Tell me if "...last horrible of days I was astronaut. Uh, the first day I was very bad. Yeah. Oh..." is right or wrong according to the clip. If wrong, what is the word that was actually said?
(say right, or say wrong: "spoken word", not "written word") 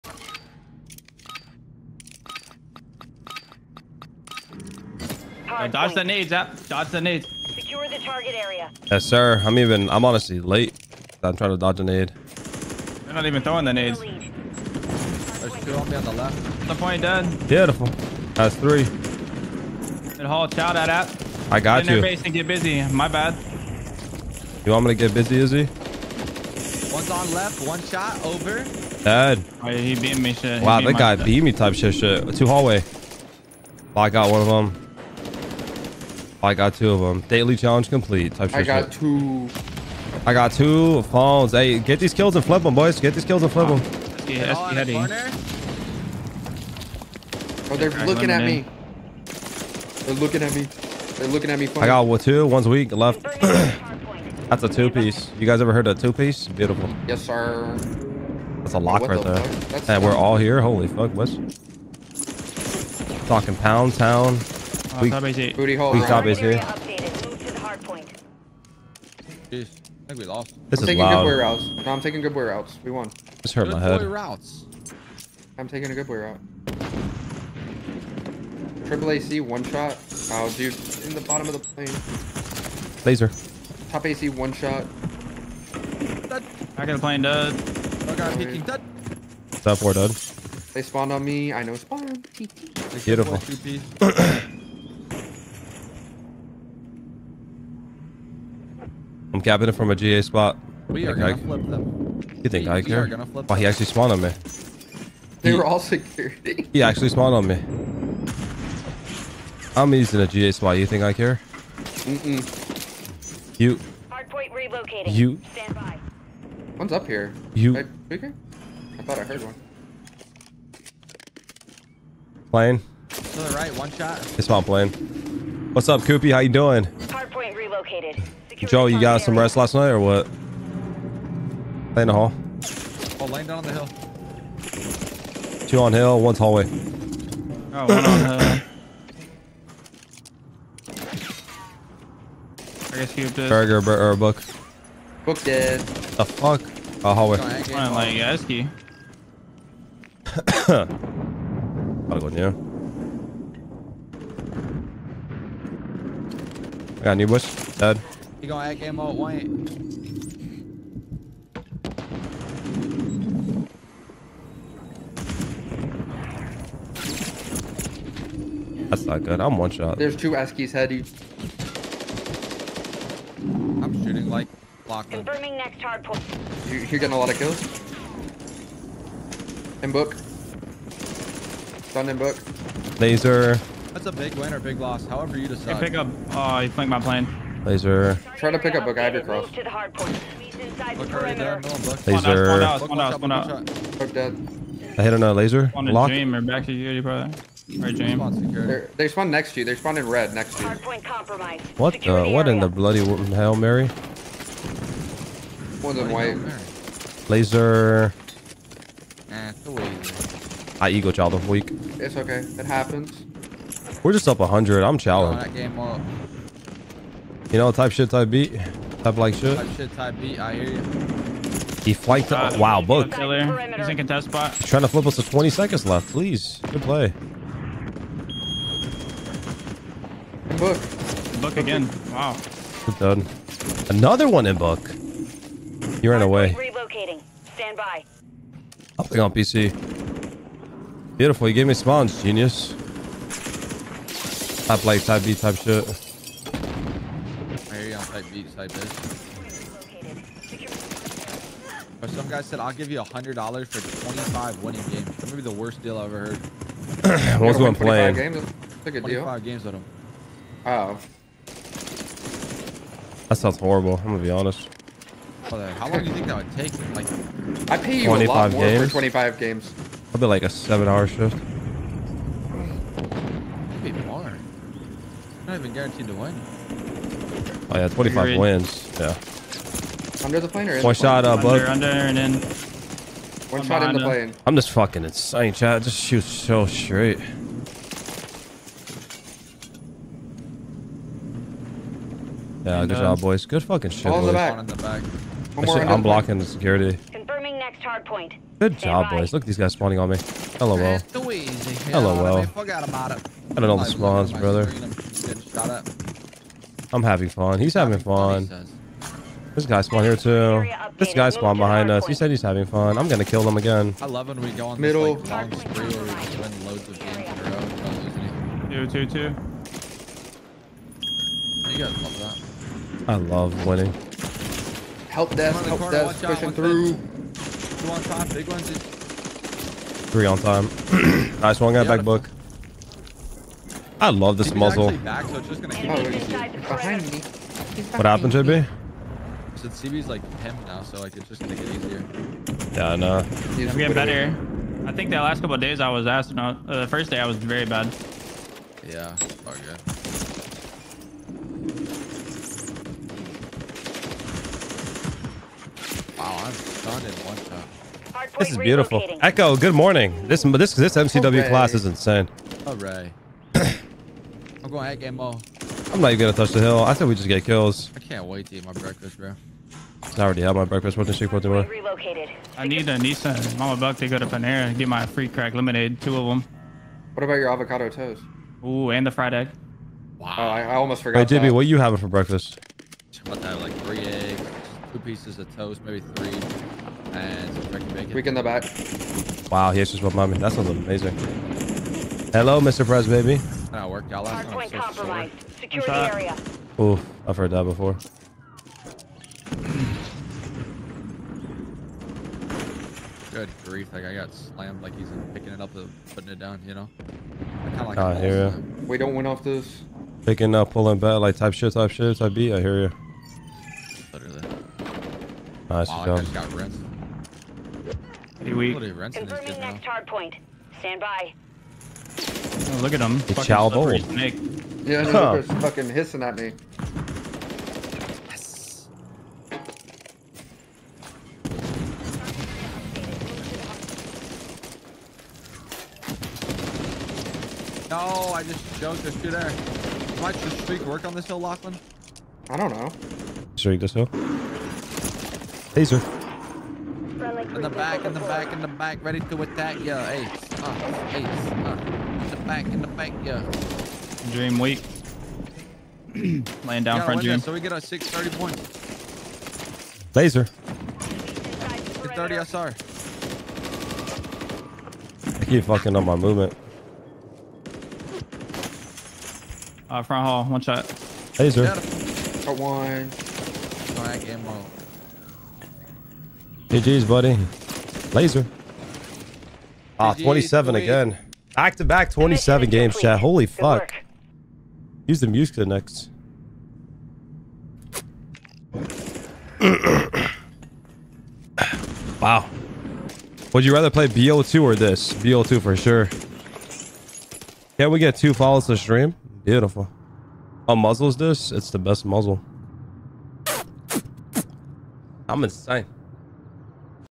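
wrong: "couple", not "horrible".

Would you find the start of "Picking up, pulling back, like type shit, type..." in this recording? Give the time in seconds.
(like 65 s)
410 s.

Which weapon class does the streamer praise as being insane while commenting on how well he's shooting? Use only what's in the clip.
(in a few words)
MCW.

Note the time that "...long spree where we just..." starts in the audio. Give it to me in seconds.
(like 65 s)
315 s.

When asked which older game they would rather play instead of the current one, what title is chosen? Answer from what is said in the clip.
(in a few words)
BO2.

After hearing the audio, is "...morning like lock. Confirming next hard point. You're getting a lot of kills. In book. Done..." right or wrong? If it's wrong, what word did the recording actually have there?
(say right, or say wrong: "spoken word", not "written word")
wrong: "shooting", not "morning".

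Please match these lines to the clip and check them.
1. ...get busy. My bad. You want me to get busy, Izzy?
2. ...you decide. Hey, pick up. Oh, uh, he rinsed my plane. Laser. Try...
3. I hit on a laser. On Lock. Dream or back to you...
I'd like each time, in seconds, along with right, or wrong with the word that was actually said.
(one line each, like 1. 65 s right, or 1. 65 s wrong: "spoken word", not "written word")
1. 22 s right
2. 185 s wrong: "flanked", not "rinsed"
3. 194 s right.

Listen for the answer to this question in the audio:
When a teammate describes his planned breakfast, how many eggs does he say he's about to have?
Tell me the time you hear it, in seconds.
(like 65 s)
383 s.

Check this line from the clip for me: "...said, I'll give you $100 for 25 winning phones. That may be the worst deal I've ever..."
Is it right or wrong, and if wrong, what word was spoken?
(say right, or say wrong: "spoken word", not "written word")
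wrong: "games", not "phones".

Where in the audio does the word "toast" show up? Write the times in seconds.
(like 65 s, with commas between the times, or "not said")
377 s, 385 s.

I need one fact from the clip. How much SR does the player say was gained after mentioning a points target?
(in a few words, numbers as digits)
30.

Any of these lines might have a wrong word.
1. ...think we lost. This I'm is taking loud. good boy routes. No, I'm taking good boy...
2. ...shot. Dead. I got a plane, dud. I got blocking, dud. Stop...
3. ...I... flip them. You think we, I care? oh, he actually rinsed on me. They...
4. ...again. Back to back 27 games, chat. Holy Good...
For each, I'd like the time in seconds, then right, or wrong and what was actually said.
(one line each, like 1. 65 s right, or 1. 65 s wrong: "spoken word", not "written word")
1. 70 s right
2. 84 s wrong: "peeking", not "blocking"
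3. 101 s wrong: "spawned", not "rinsed"
4. 480 s right.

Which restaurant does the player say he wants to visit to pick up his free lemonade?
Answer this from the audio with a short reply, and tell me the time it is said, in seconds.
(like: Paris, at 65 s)
Panera, at 374 s.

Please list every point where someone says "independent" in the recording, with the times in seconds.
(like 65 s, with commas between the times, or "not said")
not said.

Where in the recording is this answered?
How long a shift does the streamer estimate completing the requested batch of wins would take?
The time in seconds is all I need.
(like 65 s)
270 s.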